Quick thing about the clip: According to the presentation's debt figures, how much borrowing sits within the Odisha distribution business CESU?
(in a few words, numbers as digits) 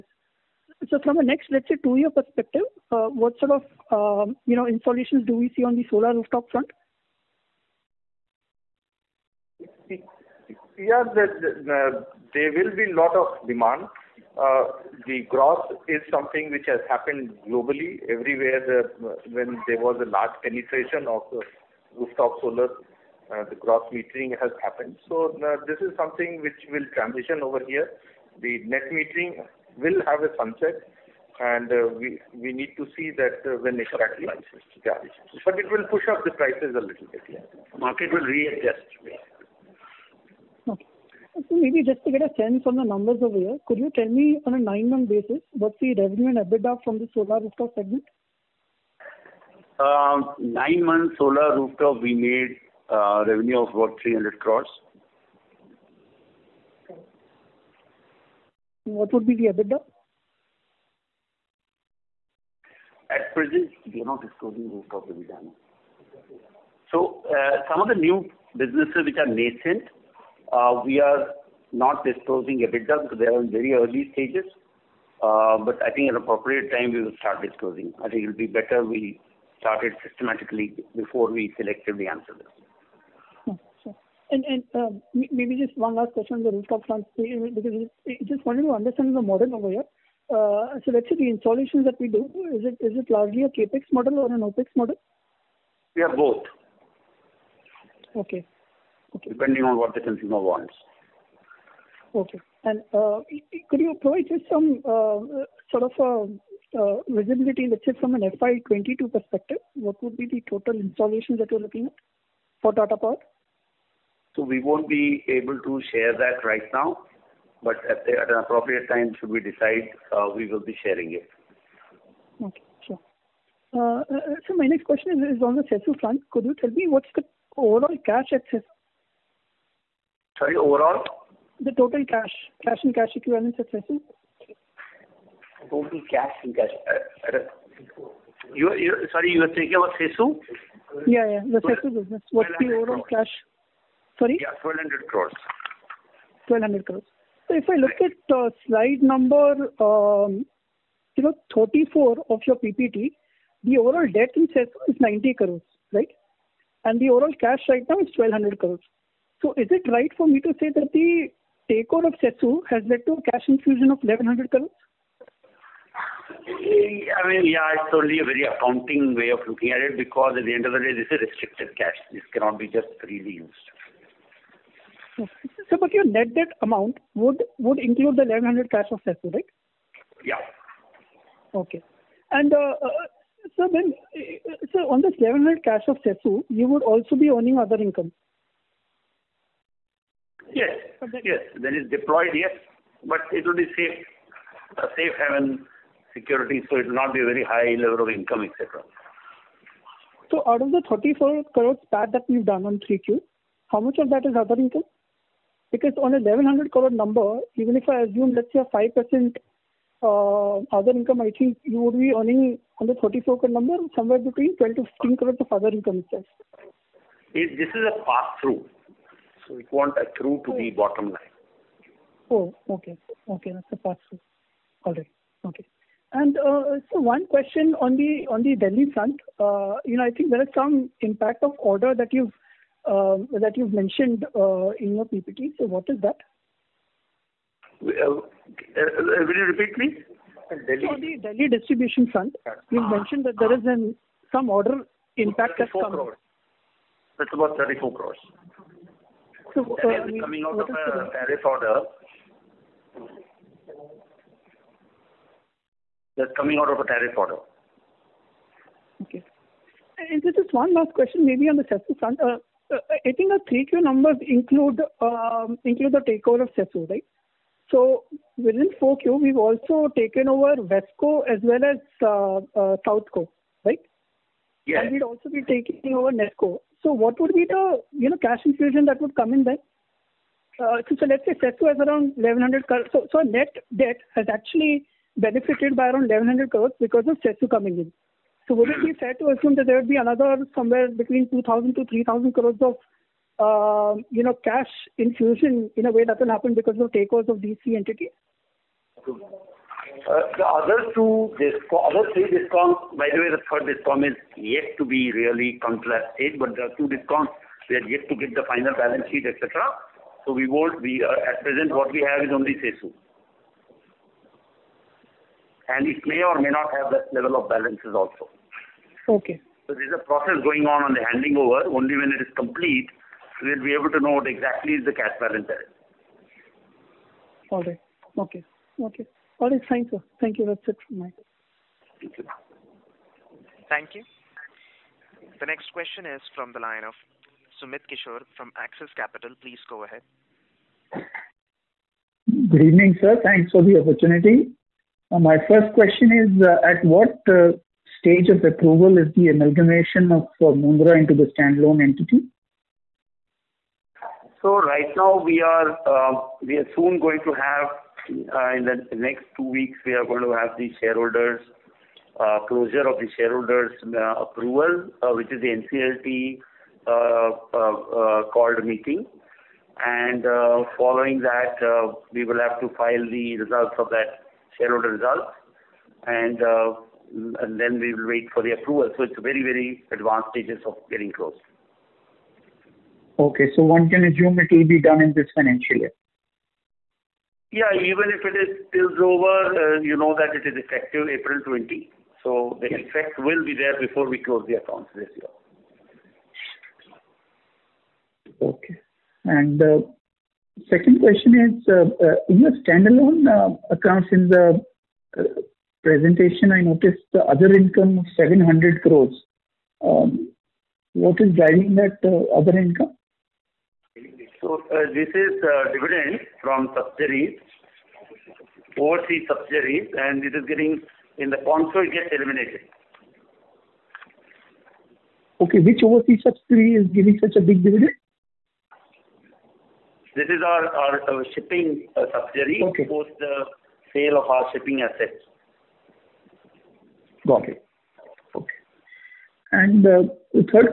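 90 crores.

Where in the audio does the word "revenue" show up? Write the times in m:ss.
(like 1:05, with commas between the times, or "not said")
0:45, 0:53.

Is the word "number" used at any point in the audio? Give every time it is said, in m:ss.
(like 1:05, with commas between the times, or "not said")
0:42, 2:29, 3:26, 3:33, 4:23.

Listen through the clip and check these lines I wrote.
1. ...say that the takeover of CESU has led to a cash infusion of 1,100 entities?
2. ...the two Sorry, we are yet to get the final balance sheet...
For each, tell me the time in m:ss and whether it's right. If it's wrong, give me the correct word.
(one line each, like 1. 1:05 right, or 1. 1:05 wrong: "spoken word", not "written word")
1. 2:40 wrong: "crores", not "entities"
2. 5:06 wrong: "DISCOMs", not "Sorry".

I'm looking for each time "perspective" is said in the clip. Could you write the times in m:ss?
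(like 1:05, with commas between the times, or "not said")
0:02, 1:49.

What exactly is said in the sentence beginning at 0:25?
So uh, This is something which will transition over here.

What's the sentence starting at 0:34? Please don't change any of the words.
It will push up the prices a little bit, yeah.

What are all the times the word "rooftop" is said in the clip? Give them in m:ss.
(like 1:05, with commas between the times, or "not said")
0:06, 0:21, 0:47, 0:51, 1:04, 1:26.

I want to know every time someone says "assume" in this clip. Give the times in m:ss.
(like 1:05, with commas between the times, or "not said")
3:28, 4:49, 6:24.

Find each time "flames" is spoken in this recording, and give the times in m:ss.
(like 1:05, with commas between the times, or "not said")
not said.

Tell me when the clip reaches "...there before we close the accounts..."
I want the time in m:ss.
6:33.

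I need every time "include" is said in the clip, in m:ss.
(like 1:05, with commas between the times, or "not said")
2:57, 4:24.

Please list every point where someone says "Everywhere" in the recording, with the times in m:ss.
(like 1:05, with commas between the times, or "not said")
0:18.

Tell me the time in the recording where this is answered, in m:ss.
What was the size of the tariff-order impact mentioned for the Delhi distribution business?
4:07.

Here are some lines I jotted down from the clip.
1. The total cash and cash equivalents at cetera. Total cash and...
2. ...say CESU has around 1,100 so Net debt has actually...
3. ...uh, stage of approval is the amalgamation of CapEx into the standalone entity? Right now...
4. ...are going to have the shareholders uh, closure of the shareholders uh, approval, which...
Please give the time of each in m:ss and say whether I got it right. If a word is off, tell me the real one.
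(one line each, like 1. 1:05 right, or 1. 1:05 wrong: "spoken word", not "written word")
1. 2:11 right
2. 4:41 right
3. 5:47 wrong: "Mundra", not "CapEx"
4. 5:59 right.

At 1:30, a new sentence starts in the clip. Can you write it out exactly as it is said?
Uh, so let's say the installations that we do, is it largely a CapEx model or an OpEx model?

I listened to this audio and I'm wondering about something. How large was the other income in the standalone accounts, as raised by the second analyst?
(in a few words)
700 crores.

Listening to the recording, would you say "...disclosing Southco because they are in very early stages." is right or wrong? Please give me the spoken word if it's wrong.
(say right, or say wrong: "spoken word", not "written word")
wrong: "EBITDA", not "Southco".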